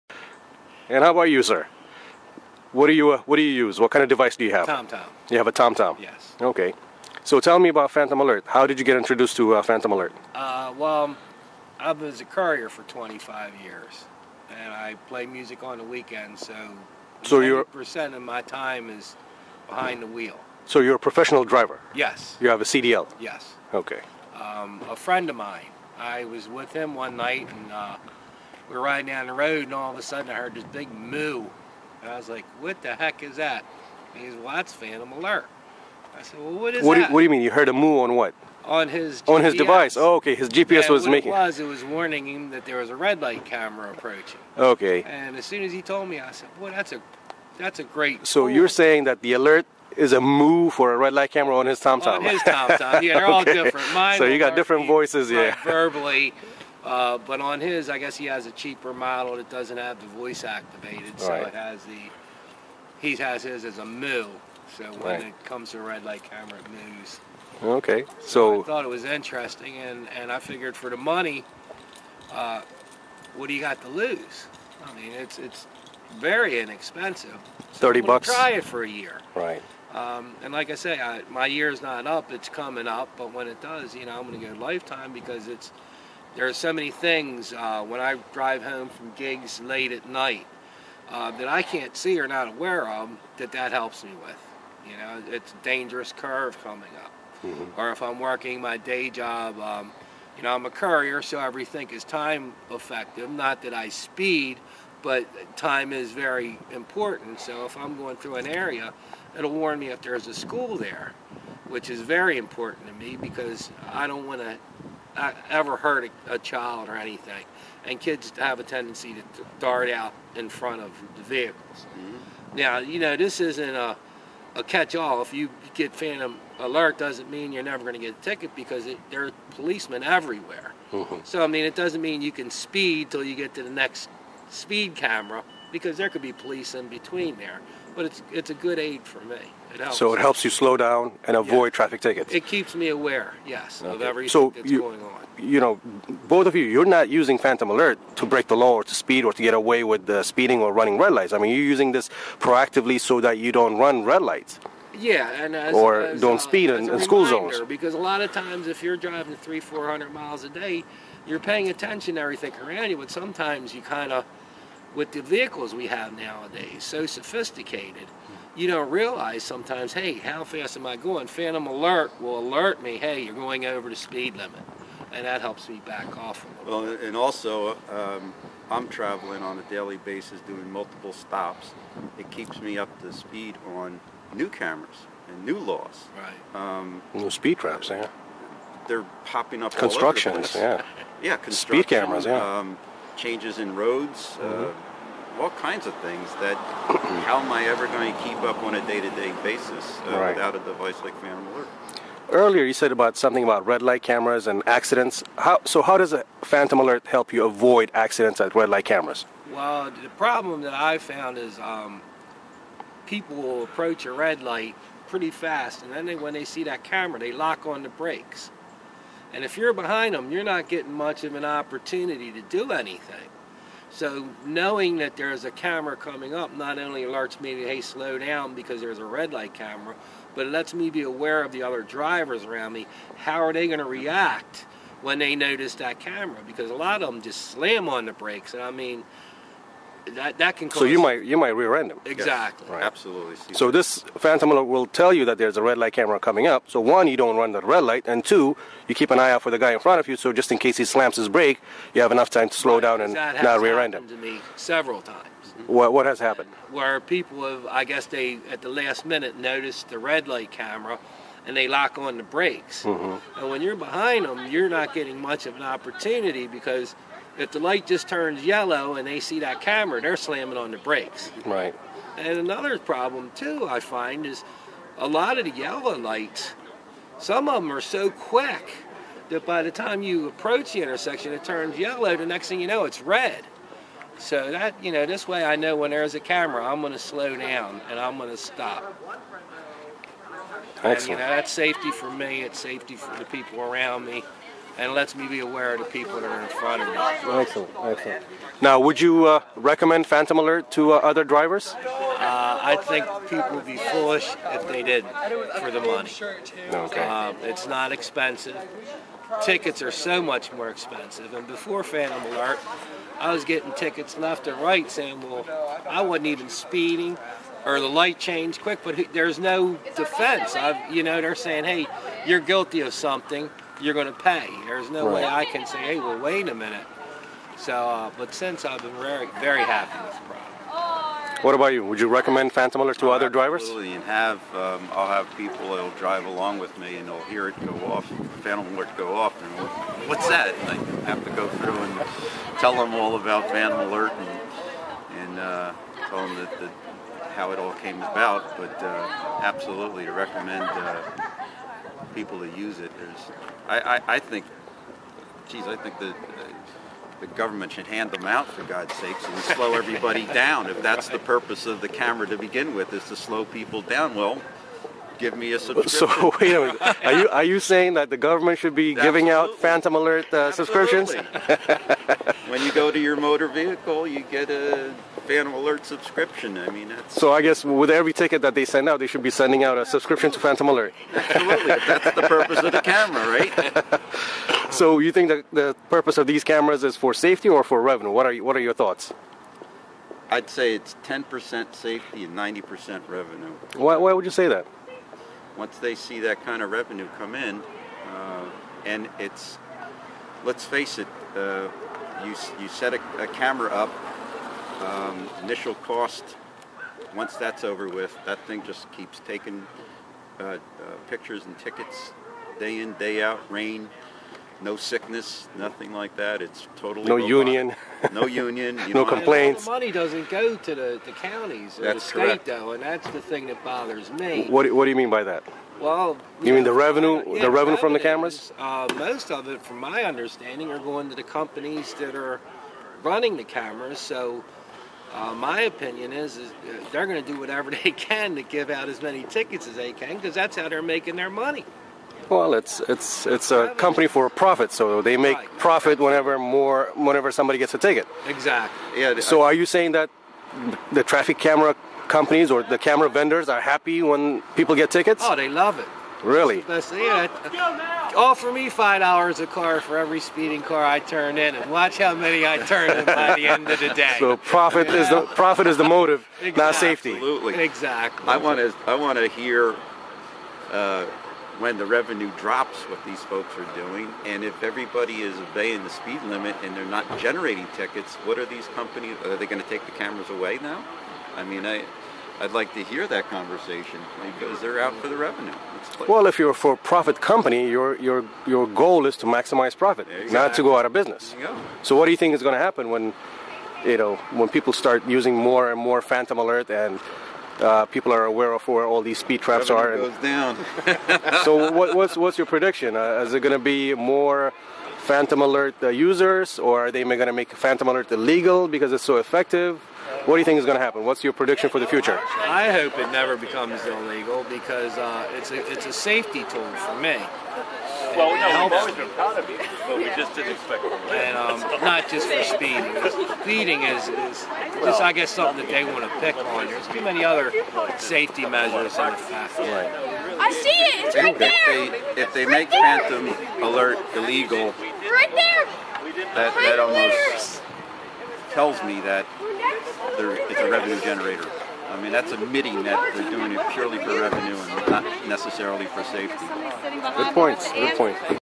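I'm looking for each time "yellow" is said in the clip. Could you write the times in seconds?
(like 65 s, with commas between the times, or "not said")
268 s, 275 s, 281 s.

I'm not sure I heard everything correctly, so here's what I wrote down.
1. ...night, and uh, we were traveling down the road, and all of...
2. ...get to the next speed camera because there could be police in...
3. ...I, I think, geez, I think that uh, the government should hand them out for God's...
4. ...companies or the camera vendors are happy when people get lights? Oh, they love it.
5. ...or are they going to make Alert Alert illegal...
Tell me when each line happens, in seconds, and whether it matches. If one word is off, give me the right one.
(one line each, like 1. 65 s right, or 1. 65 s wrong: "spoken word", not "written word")
1. 27 s wrong: "riding", not "traveling"
2. 133 s right
3. 353 s right
4. 452 s wrong: "tickets", not "lights"
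5. 506 s wrong: "Phantom", not "Alert".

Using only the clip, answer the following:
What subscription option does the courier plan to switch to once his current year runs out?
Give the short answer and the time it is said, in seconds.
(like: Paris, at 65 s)
lifetime, at 84 s.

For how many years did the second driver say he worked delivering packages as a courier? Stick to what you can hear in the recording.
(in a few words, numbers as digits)
25.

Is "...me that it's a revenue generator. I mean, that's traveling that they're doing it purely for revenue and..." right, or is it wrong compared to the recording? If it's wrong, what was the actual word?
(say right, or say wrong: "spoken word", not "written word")
wrong: "admitting", not "traveling".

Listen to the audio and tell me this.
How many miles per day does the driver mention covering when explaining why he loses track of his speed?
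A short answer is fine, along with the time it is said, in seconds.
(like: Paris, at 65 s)
300 to 400, at 159 s.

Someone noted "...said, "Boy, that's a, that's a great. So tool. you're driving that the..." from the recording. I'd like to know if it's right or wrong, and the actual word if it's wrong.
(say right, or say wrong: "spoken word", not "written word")
wrong: "saying", not "driving".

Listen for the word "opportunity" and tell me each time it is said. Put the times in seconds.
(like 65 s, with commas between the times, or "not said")
221 s, 265 s.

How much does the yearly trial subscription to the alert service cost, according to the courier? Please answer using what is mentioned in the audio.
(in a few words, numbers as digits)
$30.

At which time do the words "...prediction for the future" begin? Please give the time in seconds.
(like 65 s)
511 s.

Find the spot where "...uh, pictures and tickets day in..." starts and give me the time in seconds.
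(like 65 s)
410 s.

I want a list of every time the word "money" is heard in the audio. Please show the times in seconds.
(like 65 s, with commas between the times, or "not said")
70 s, 305 s, 419 s, 441 s.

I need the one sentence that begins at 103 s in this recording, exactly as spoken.
Not that I speed, but time is very important.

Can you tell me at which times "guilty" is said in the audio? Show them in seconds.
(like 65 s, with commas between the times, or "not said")
322 s.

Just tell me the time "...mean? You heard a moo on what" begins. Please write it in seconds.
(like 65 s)
37 s.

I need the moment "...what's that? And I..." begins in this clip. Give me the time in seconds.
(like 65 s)
340 s.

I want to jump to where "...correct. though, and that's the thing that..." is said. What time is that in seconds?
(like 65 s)
422 s.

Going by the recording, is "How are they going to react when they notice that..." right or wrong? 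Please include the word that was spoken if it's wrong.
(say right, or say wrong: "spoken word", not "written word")
right.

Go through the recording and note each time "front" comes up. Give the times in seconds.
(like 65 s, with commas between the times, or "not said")
120 s, 249 s, 296 s.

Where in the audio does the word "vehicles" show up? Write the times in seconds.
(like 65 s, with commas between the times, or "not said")
121 s, 165 s, 373 s.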